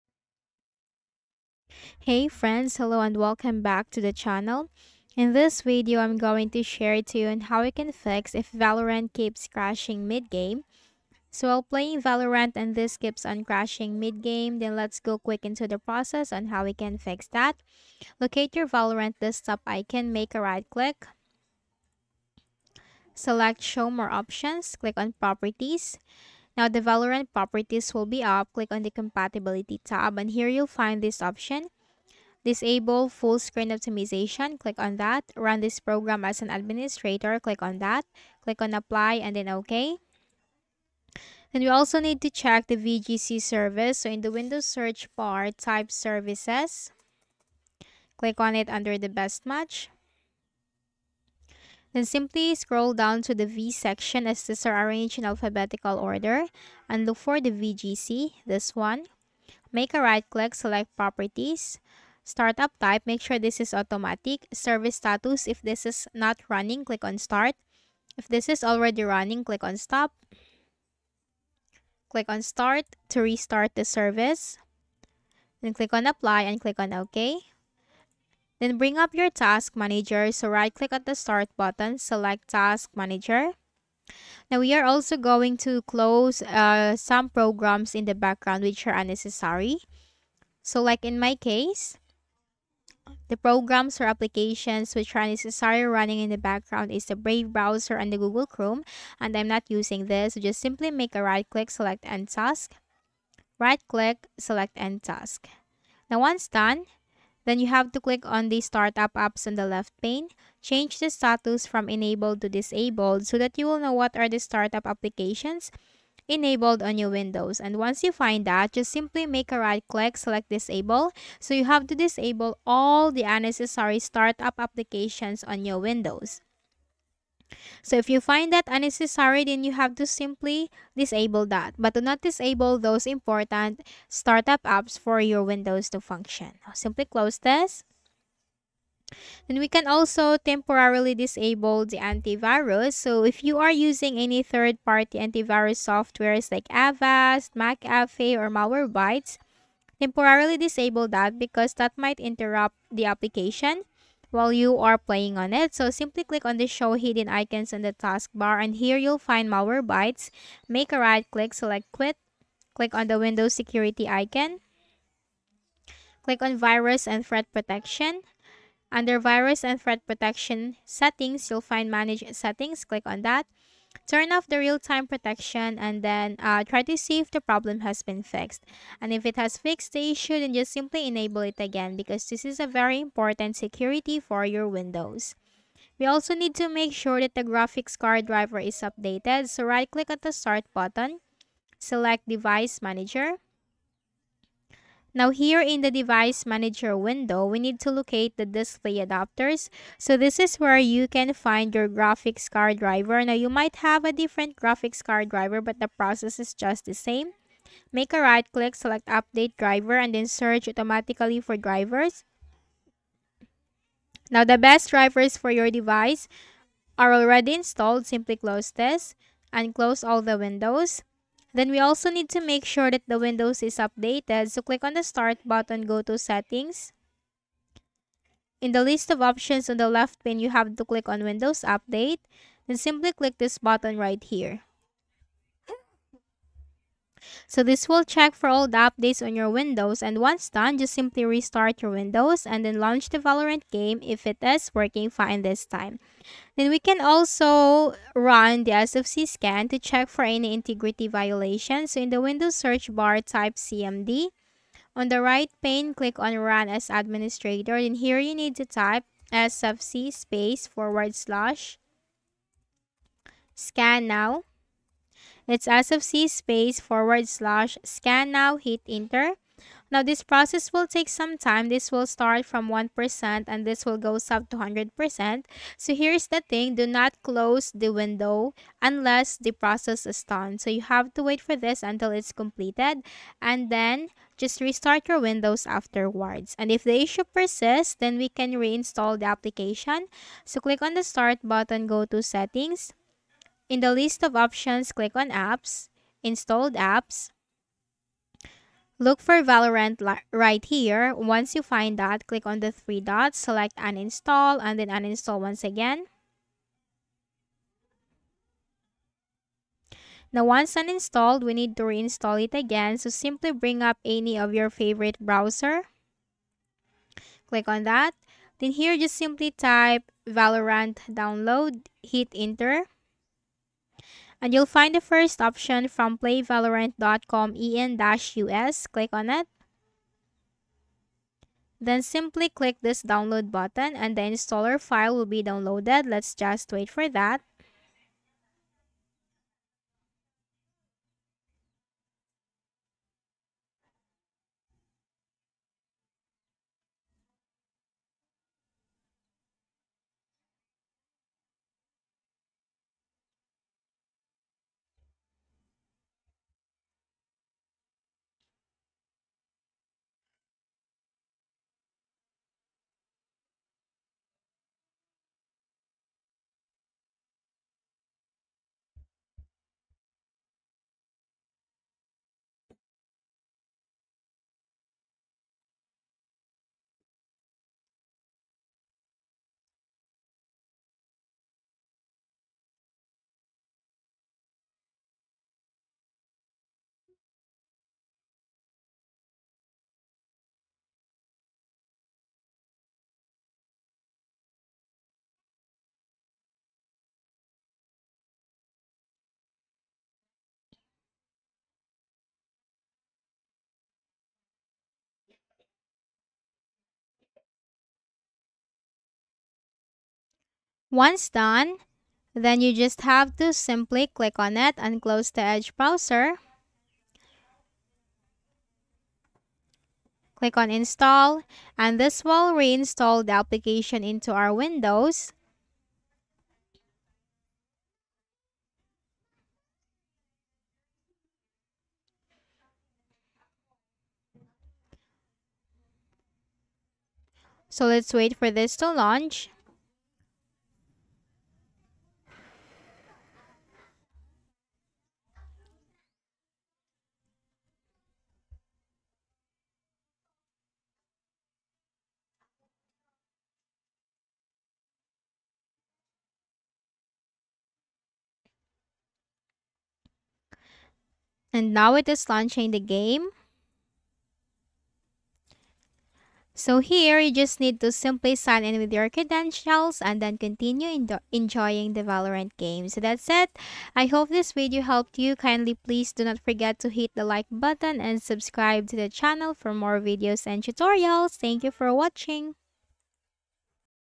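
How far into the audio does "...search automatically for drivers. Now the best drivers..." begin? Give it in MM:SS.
03:30.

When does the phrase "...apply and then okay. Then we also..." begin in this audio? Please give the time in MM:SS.
00:38.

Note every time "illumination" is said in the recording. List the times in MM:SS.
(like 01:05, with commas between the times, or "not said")
not said.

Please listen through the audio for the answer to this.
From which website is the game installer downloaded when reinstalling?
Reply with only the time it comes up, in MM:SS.
05:26.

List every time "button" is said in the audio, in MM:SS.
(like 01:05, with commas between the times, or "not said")
01:21, 03:10, 03:45, 03:53, 04:51, 05:33, 07:57.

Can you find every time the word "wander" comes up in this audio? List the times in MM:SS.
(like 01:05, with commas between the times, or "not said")
not said.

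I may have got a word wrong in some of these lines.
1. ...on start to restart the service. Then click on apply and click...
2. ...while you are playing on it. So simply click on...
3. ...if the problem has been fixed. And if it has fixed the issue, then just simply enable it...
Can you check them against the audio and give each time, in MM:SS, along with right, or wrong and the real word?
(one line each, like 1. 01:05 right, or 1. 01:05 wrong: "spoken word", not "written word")
1. 01:12 right
2. 02:34 right
3. 02:57 right.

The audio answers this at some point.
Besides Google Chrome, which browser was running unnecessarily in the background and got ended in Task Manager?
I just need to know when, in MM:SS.
01:37.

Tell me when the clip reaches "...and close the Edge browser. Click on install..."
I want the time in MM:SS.
06:54.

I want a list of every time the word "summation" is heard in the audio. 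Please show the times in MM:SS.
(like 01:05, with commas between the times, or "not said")
not said.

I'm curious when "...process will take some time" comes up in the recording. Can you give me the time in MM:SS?
04:30.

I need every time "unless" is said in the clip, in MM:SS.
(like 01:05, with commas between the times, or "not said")
04:38.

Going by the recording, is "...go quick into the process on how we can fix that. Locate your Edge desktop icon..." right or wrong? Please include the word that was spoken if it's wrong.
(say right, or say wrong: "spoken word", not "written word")
wrong: "Valorant", not "Edge".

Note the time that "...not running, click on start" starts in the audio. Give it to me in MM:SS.
01:06.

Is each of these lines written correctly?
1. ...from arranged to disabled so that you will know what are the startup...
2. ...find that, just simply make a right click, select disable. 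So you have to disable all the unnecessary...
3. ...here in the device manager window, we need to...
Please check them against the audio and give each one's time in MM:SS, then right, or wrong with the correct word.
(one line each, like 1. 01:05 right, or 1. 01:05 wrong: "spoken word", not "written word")
1. 01:51 wrong: "enabled", not "arranged"
2. 01:58 right
3. 03:15 right.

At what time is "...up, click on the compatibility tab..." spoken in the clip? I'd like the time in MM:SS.
00:28.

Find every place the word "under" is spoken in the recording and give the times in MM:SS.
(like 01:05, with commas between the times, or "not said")
00:48, 02:48.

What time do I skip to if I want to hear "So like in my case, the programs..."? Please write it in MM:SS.
01:30.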